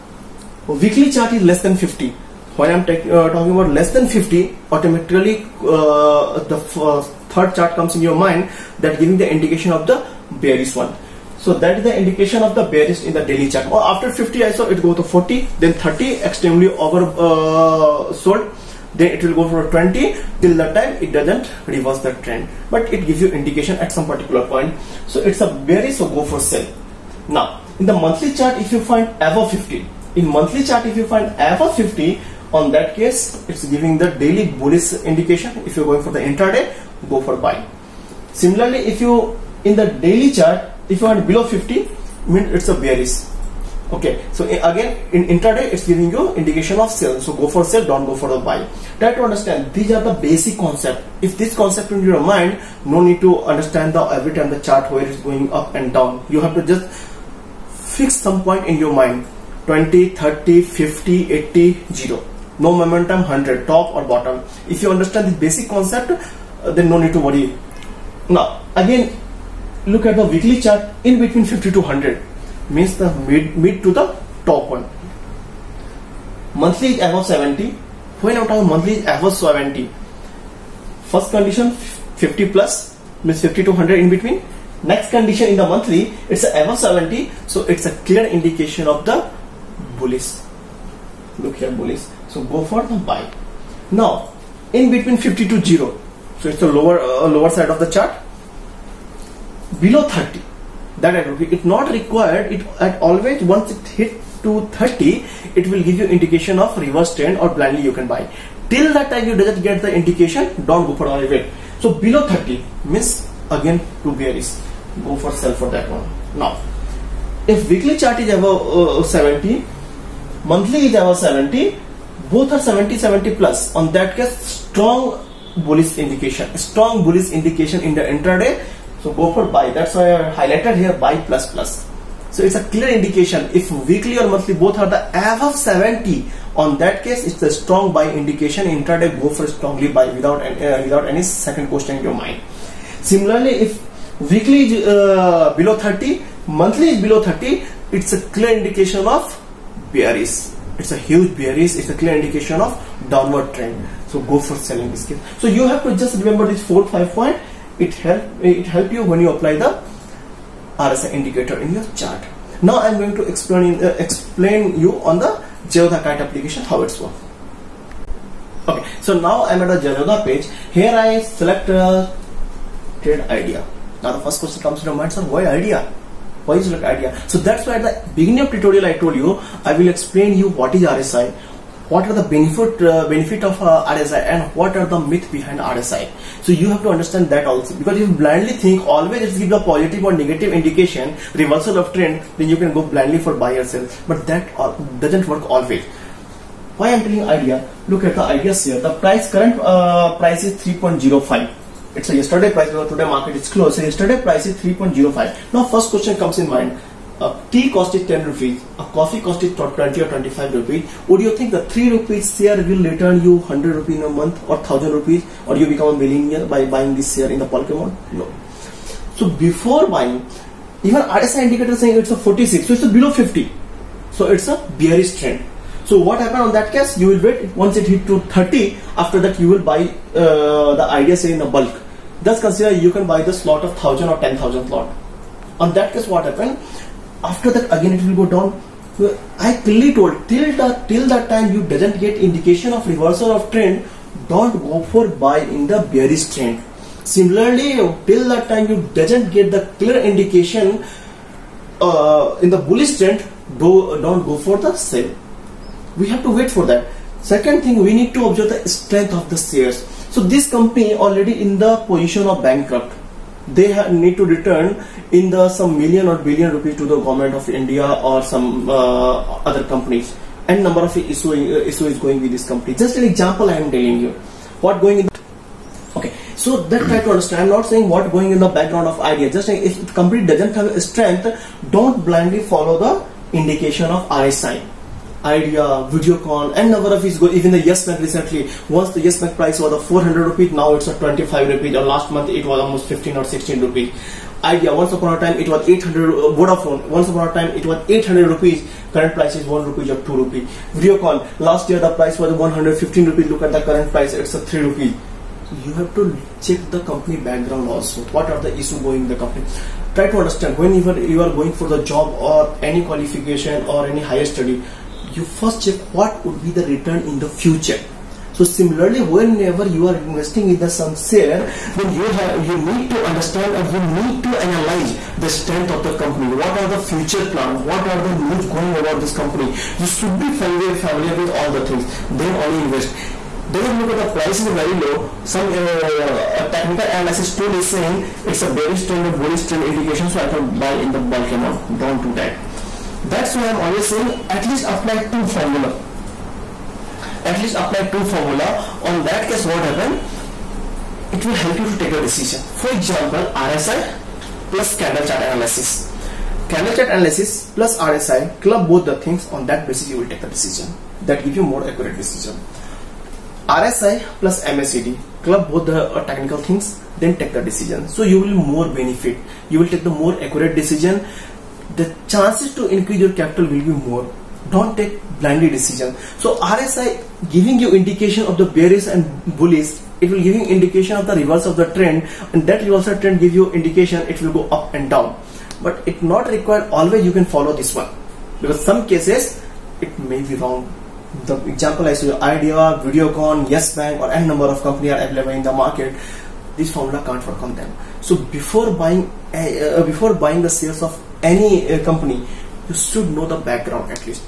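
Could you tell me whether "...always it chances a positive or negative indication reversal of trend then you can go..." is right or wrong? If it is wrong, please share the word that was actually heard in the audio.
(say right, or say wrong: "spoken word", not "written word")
wrong: "gives", not "chances".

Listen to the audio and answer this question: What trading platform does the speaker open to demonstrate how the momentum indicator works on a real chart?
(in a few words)
Zerodha Kite.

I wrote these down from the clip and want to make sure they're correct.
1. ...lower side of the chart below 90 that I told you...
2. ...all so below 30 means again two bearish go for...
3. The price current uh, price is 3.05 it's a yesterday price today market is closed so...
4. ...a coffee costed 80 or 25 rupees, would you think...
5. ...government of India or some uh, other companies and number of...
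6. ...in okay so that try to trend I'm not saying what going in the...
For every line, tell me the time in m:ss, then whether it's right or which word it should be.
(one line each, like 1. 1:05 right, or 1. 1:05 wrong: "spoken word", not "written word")
1. 1:37 wrong: "30", not "90"
2. 1:51 right
3. 3:18 right
4. 3:28 wrong: "20", not "80"
5. 4:26 right
6. 4:34 wrong: "understand", not "trend".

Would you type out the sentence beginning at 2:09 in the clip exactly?
That's why I highlighted here buy plus plus.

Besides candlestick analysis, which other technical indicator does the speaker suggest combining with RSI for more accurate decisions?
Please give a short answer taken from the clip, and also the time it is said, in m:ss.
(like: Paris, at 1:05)
MACD, at 6:04.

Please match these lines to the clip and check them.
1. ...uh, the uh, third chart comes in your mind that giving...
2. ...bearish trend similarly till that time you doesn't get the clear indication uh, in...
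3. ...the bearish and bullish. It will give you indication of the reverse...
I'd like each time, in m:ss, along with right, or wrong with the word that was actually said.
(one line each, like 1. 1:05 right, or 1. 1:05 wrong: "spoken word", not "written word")
1. 0:05 right
2. 4:05 right
3. 6:18 right.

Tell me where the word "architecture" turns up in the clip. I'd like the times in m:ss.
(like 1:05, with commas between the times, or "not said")
not said.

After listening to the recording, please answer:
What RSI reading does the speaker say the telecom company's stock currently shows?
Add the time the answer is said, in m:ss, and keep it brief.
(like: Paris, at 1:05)
46, at 3:42.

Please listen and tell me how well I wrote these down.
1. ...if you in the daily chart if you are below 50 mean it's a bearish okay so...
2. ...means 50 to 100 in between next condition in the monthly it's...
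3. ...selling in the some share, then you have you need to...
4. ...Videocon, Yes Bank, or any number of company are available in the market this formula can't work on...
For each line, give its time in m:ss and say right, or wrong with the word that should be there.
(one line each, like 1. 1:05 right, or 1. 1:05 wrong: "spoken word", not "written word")
1. 0:38 right
2. 1:23 right
3. 5:19 wrong: "investing", not "selling"
4. 6:32 right.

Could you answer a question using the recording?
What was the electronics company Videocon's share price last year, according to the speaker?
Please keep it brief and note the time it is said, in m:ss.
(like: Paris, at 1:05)
115 rupees, at 5:02.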